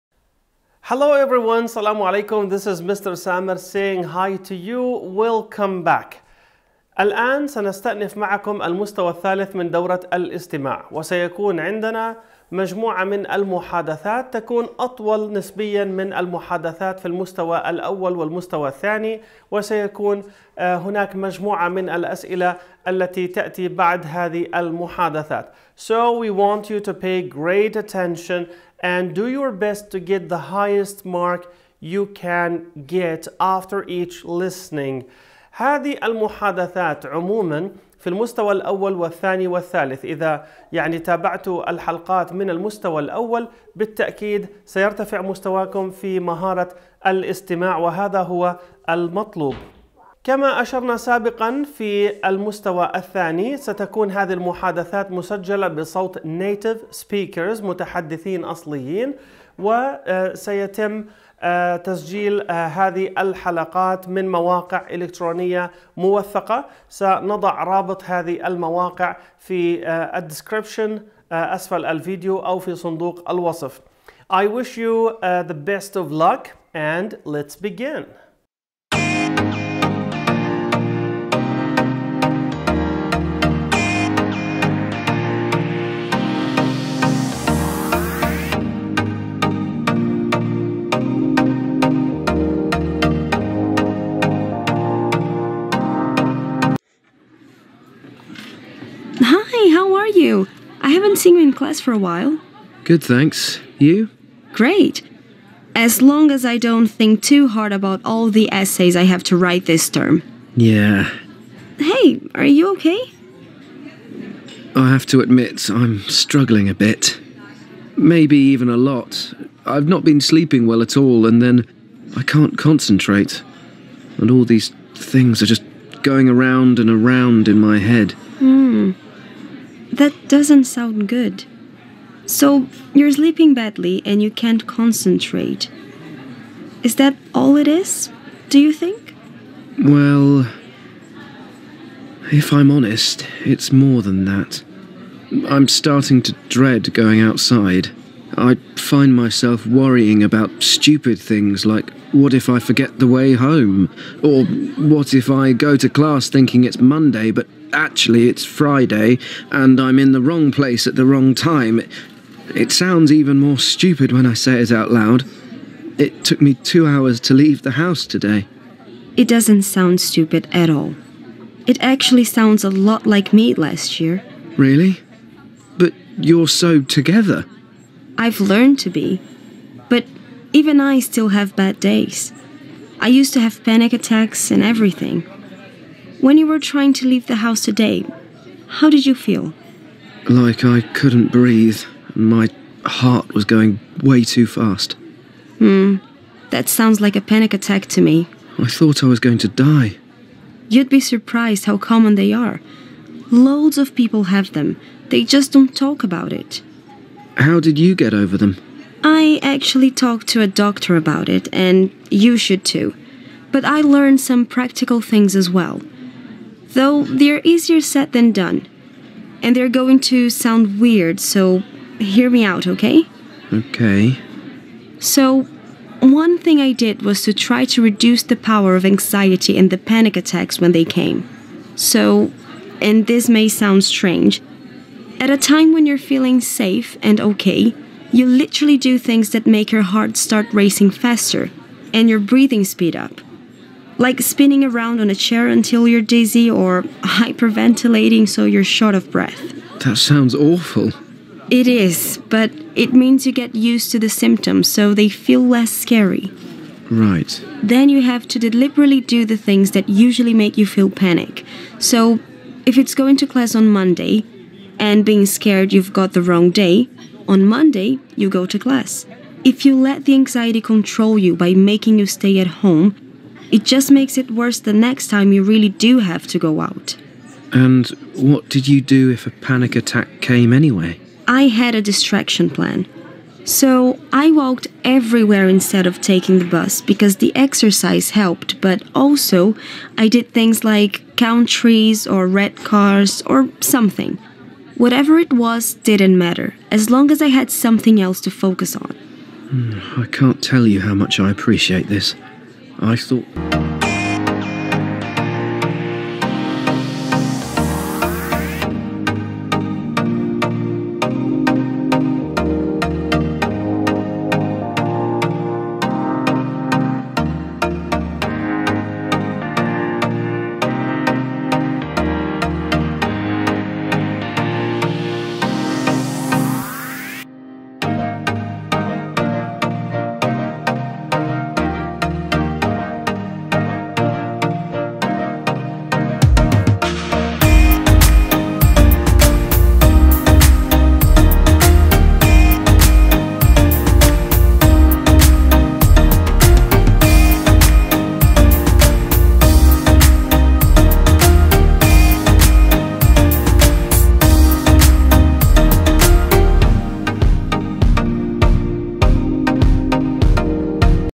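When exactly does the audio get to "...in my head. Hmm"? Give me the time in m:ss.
2:07.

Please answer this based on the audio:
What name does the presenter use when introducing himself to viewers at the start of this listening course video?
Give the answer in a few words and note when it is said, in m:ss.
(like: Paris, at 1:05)
Mr. Samer, at 0:02.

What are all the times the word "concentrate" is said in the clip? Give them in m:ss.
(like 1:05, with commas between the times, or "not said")
2:02, 2:14.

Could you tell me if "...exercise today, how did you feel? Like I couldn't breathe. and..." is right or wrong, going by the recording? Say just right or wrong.
wrong.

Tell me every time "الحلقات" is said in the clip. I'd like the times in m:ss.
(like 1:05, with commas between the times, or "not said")
0:41, 1:03.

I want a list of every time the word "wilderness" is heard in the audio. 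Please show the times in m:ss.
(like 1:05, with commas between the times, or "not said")
not said.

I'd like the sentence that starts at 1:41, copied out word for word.
haven't seen you in class for a while.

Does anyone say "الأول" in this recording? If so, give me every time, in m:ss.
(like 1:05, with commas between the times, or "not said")
0:17, 0:38, 0:43.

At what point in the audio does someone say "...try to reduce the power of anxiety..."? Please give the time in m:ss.
3:47.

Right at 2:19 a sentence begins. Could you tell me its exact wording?
Well, if I'm honest, it's more than that.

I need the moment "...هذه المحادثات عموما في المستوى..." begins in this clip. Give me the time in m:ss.
0:35.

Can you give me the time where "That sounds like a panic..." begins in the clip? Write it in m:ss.
3:16.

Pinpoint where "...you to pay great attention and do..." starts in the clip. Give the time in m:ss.
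0:26.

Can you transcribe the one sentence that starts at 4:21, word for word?
So, if it's going to class on Monday and being scared you've got the wrong day, on Monday you go to class.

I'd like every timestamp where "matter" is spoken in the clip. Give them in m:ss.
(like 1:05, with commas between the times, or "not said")
4:56.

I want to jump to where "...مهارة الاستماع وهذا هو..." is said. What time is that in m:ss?
0:46.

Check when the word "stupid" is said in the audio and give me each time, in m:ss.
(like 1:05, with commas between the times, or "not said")
2:30, 2:43, 2:50.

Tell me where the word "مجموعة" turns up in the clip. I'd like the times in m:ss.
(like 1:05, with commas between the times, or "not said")
0:12, 0:21.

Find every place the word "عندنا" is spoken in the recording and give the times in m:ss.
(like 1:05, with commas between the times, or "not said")
0:11.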